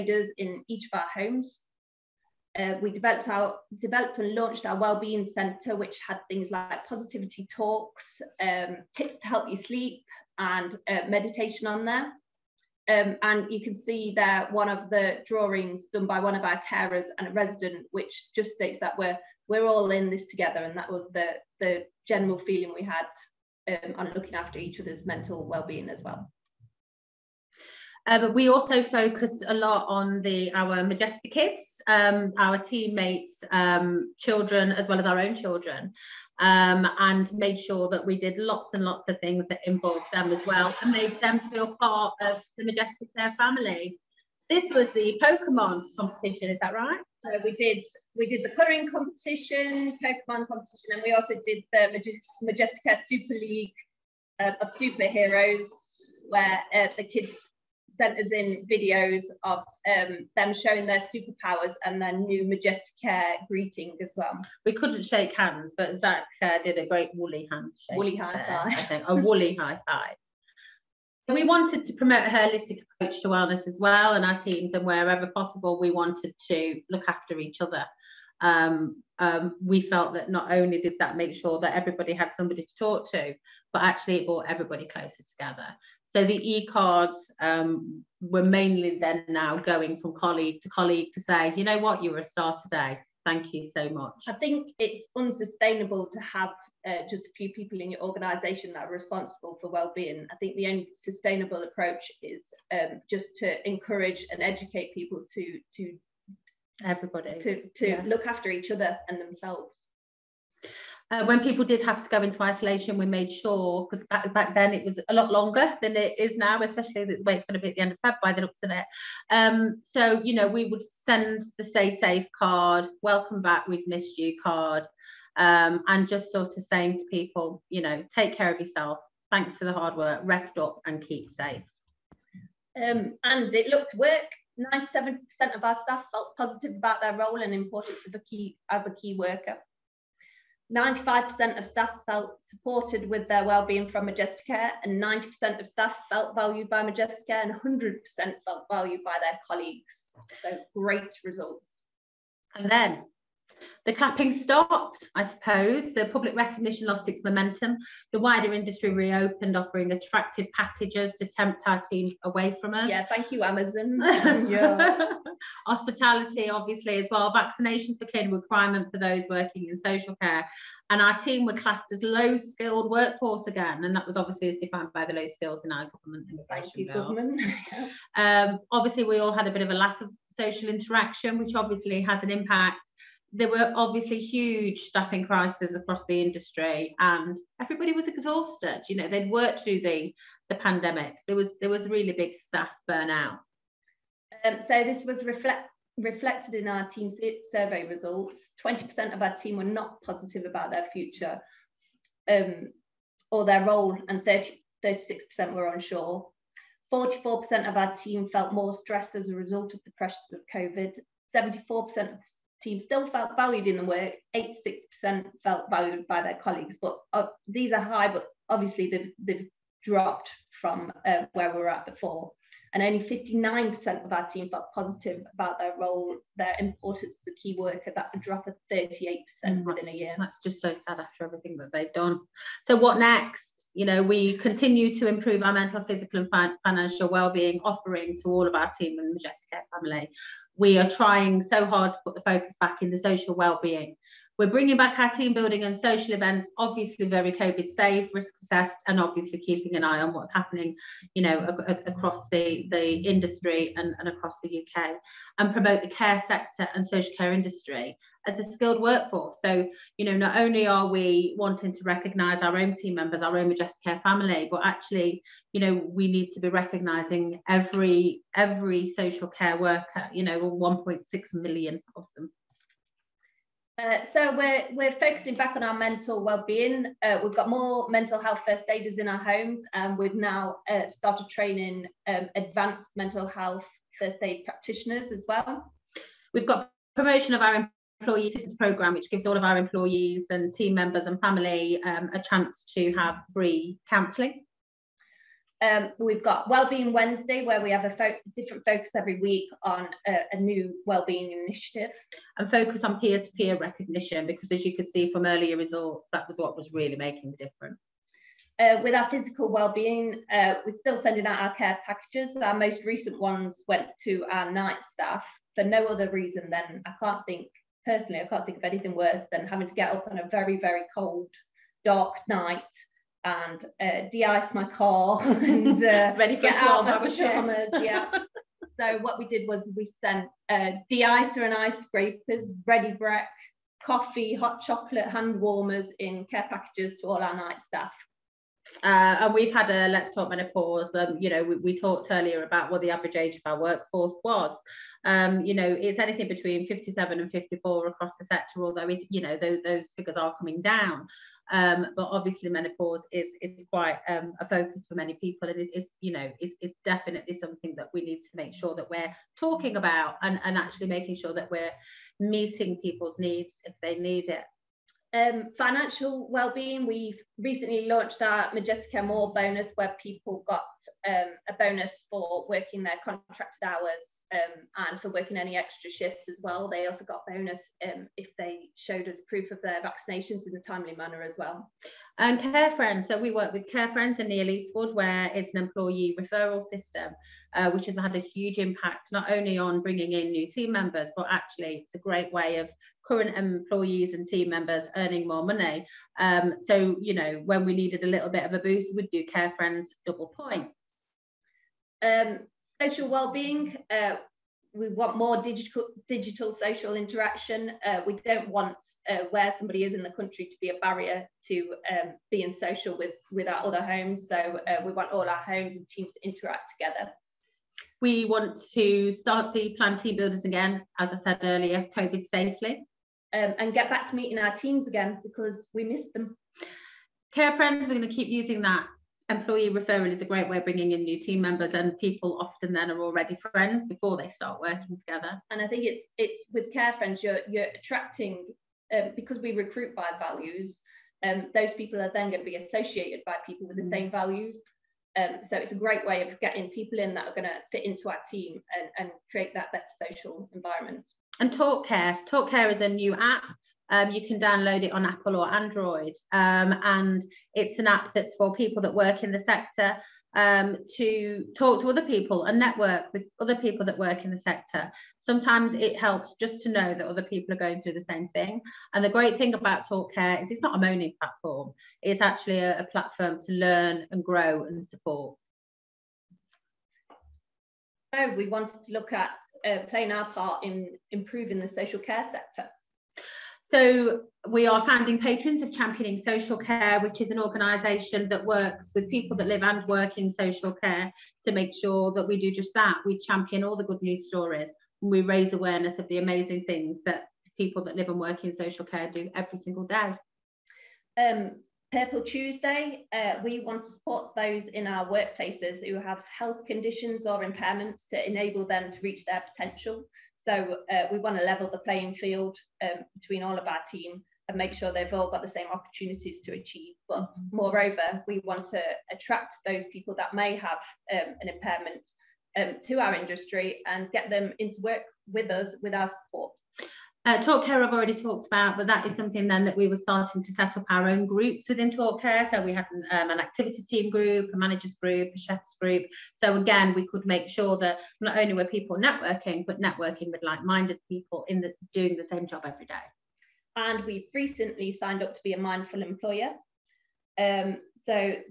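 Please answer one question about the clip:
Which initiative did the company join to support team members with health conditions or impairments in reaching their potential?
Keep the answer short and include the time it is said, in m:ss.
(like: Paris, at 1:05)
Purple Tuesday, at 8:21.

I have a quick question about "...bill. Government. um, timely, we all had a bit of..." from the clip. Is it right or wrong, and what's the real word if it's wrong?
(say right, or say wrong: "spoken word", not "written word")
wrong: "obviously", not "timely".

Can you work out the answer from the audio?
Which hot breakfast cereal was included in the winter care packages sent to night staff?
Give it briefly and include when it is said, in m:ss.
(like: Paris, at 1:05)
Ready Brek, at 5:32.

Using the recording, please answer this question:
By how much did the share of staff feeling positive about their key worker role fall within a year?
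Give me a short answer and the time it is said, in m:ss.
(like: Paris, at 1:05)
38%, at 3:48.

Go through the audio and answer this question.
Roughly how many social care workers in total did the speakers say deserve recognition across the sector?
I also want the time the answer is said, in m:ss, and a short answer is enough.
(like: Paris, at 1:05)
1.6 million, at 4:30.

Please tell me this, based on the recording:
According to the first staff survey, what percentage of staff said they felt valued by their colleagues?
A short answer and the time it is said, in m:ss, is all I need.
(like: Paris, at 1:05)
100%, at 2:27.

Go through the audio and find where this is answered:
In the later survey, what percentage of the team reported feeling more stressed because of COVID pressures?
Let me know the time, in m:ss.
3:26.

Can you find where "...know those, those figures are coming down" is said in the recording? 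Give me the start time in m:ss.
5:49.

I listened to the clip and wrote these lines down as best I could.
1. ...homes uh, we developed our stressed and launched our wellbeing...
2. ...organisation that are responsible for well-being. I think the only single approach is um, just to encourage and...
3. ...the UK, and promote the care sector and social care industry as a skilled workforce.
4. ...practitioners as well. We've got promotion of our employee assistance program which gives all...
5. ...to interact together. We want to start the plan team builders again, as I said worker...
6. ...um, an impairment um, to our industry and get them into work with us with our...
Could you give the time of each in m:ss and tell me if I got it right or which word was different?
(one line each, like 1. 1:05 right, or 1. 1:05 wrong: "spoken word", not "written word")
1. 0:01 wrong: "developed", not "stressed"
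2. 1:37 wrong: "sustainable", not "single"
3. 4:14 right
4. 4:44 right
5. 6:56 wrong: "earlier", not "worker"
6. 8:41 right.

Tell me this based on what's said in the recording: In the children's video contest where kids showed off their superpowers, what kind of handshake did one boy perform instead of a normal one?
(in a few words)
woolly handshake.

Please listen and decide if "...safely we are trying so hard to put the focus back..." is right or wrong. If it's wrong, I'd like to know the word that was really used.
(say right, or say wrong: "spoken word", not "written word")
wrong: "family", not "safely".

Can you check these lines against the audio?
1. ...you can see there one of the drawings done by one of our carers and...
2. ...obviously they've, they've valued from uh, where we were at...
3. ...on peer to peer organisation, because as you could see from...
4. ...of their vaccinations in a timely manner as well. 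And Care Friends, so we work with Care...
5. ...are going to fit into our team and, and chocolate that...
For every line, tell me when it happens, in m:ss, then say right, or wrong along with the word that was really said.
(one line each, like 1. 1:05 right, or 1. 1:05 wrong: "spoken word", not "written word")
1. 0:13 right
2. 3:38 wrong: "dropped", not "valued"
3. 5:02 wrong: "recognition", not "organisation"
4. 6:19 right
5. 7:27 wrong: "create", not "chocolate".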